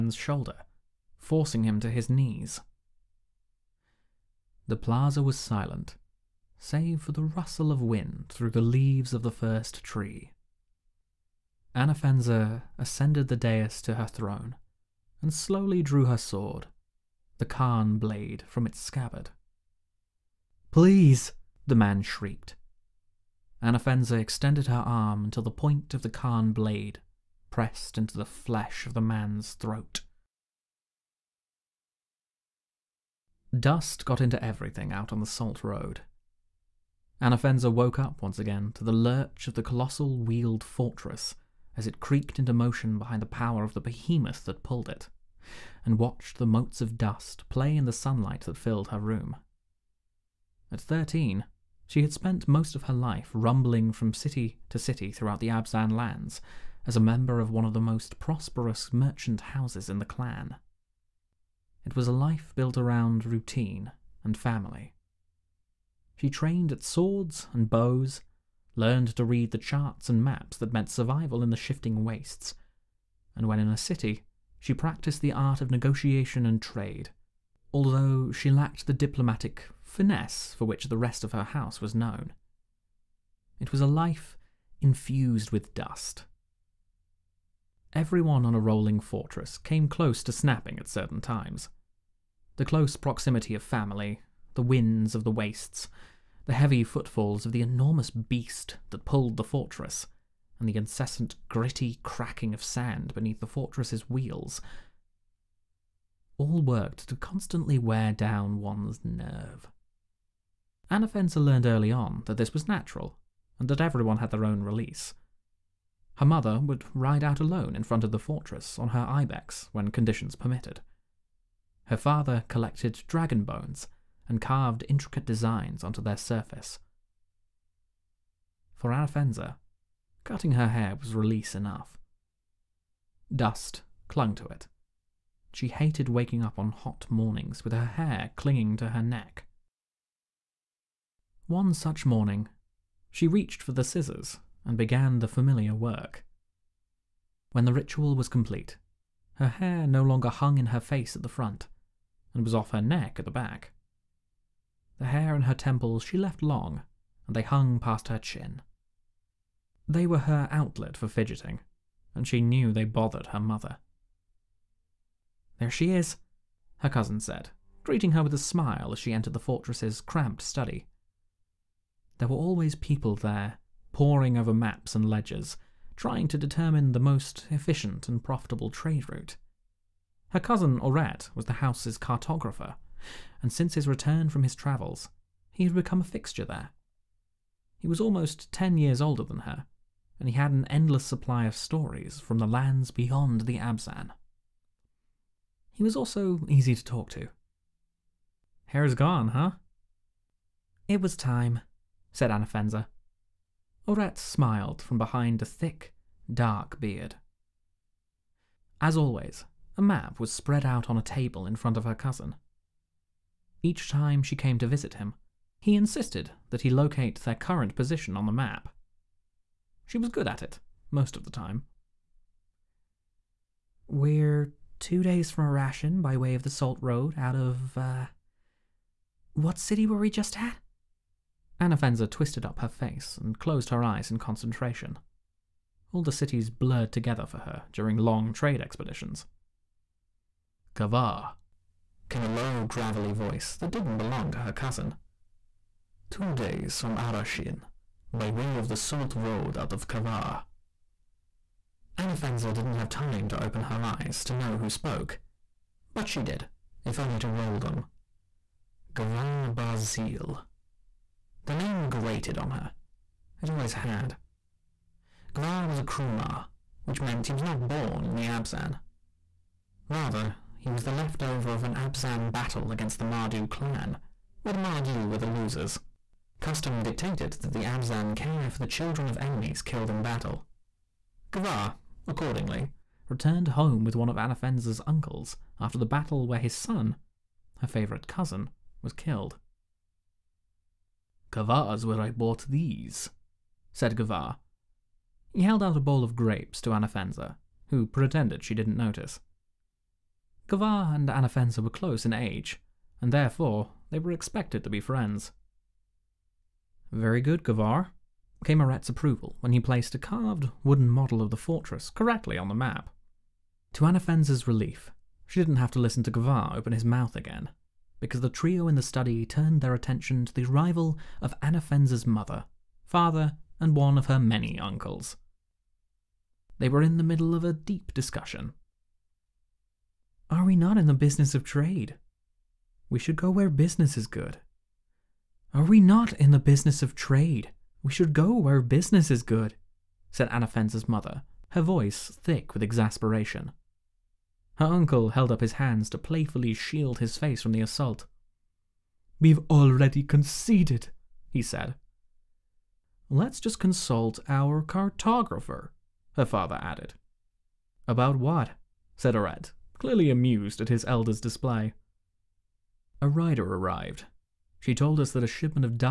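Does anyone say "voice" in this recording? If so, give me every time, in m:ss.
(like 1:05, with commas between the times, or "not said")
4:03, 5:41.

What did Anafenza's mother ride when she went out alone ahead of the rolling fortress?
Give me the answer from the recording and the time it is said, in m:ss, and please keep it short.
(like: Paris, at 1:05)
ibex, at 1:59.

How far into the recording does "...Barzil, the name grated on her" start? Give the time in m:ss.
4:19.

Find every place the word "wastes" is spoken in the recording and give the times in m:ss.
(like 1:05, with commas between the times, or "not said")
1:12, 1:35.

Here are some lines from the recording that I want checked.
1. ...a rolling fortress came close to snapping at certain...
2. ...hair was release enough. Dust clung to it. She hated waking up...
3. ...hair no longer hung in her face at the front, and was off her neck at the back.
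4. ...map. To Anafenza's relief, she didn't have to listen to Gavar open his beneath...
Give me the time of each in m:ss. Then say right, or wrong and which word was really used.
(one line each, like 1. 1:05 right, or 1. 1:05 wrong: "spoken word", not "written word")
1. 1:28 right
2. 2:10 right
3. 2:29 right
4. 5:12 wrong: "mouth", not "beneath".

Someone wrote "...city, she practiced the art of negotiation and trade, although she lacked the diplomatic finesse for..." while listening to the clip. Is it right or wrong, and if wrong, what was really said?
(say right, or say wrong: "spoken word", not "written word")
right.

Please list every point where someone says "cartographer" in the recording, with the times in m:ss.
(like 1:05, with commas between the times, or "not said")
3:01, 5:54.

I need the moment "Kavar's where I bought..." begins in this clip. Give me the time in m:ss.
4:51.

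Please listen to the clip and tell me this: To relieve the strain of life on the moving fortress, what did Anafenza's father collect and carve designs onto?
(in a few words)
dragon bones.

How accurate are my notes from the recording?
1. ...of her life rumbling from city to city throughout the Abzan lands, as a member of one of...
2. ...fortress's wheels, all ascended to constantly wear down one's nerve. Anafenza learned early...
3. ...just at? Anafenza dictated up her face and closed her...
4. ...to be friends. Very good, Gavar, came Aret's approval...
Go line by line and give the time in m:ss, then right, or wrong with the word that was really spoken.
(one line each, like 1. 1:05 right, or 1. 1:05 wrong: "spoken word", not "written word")
1. 0:52 right
2. 1:43 wrong: "worked", not "ascended"
3. 3:50 wrong: "twisted", not "dictated"
4. 5:04 right.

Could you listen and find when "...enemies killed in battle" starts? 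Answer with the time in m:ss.
4:39.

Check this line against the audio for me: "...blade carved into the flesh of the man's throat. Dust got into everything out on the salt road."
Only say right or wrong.
wrong.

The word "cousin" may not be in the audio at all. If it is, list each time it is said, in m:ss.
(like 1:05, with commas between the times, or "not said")
2:46, 3:00, 3:31, 4:04, 4:48.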